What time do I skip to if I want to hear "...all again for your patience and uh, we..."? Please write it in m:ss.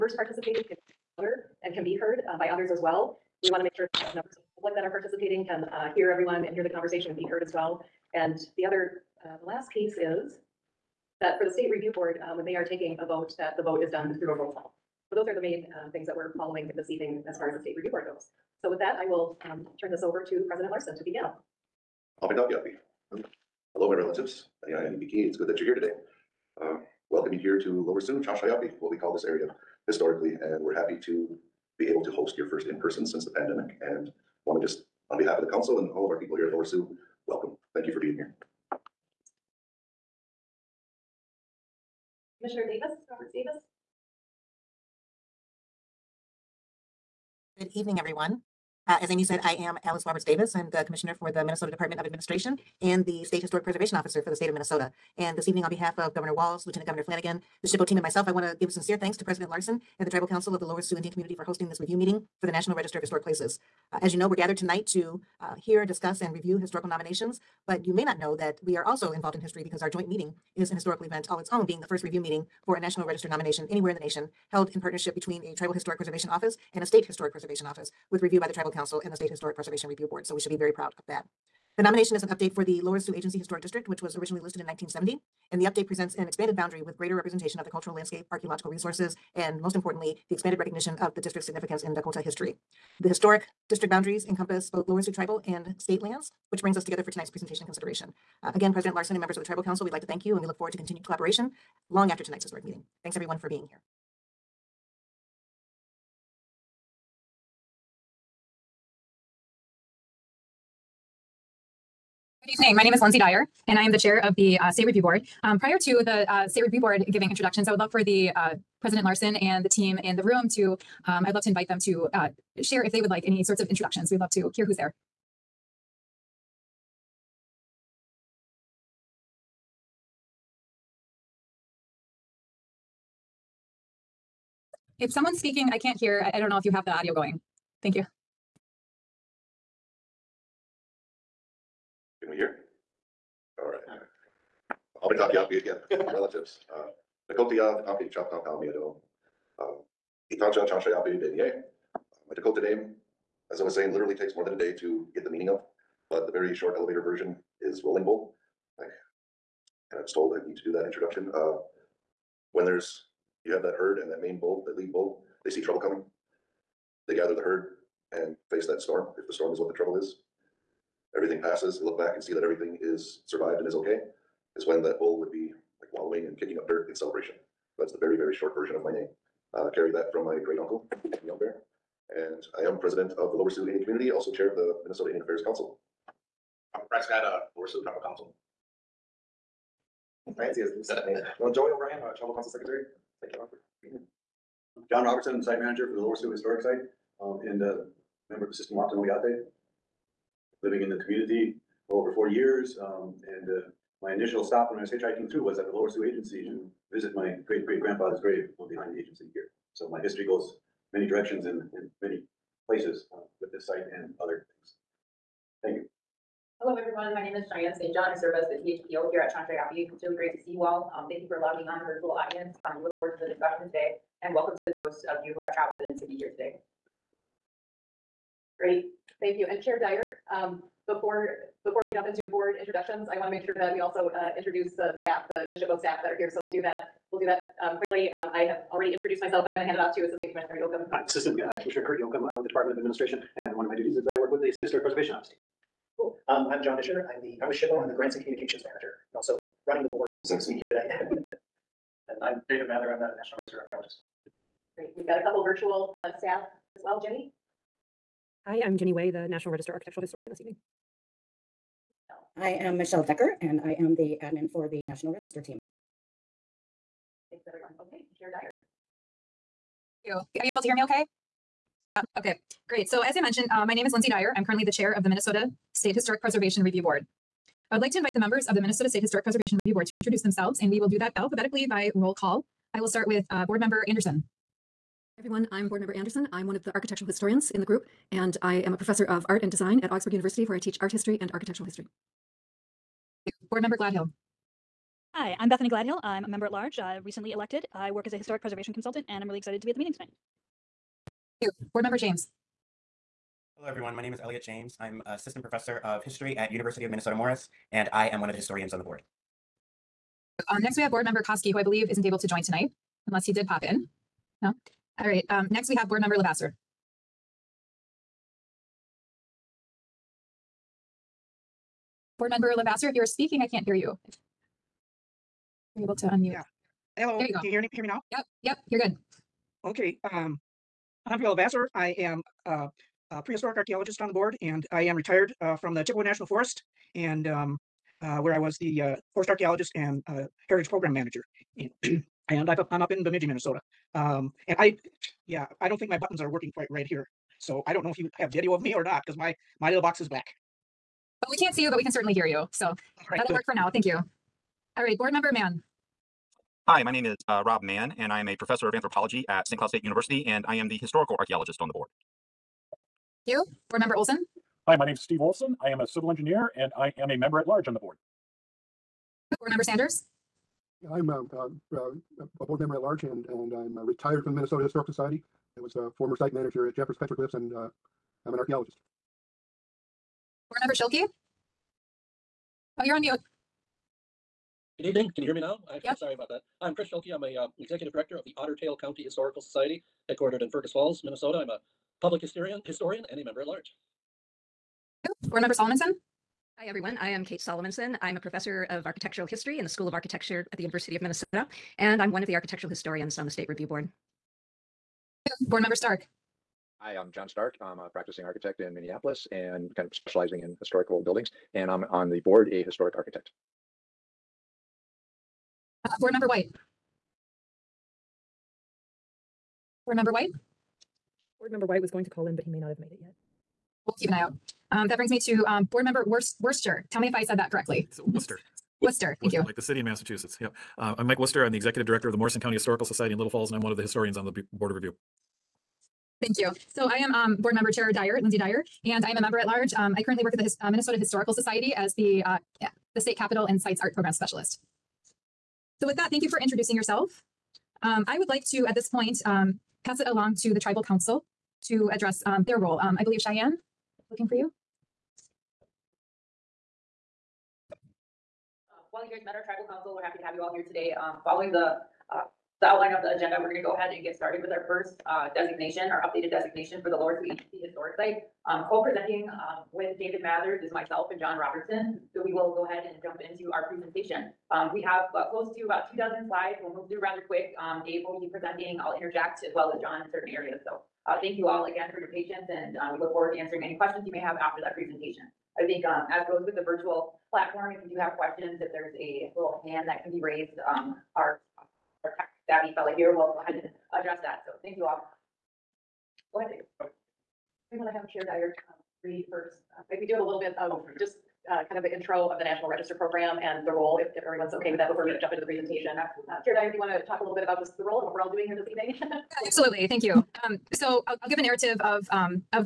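8:01.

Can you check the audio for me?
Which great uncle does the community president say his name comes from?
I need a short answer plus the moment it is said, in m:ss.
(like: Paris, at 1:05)
Young Bear, at 3:01.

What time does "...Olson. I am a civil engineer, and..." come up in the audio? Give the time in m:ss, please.
6:05.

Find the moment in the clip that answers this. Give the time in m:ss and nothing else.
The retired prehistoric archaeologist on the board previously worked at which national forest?
5:35.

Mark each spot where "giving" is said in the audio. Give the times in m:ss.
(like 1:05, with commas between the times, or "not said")
1:57.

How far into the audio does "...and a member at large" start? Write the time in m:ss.
6:33.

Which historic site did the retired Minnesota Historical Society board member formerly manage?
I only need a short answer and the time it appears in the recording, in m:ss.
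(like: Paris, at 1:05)
Jeffers Petroglyphs, at 6:16.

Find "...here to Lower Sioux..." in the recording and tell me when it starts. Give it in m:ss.
0:27.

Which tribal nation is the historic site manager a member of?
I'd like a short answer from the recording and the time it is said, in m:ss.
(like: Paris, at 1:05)
Sisseton Wahpeton Oyate, at 3:18.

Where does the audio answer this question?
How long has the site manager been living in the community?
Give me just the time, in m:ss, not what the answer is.
3:22.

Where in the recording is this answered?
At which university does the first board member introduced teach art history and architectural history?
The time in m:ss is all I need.
4:49.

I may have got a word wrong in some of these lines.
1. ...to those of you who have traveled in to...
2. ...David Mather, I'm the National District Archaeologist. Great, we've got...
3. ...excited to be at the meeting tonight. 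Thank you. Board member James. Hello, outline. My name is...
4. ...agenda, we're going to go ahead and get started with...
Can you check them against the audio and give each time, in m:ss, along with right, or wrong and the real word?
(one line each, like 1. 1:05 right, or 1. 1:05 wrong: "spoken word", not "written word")
1. 3:44 right
2. 4:12 wrong: "Register", not "District"
3. 4:59 wrong: "everyone", not "outline"
4. 7:43 right.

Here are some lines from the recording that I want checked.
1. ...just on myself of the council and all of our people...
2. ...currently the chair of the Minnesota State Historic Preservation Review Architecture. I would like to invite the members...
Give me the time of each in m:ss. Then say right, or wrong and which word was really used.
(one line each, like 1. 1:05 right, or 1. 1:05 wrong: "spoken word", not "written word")
1. 0:34 wrong: "behalf", not "myself"
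2. 4:34 wrong: "Board", not "Architecture".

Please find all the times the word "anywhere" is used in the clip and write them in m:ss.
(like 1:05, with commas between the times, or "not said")
1:13.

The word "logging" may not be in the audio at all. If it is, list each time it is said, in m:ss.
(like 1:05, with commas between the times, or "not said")
3:41.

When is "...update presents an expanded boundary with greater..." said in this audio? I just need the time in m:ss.
1:25.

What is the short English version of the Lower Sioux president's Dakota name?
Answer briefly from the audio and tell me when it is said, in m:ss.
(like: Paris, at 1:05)
Rolling Bull, at 2:37.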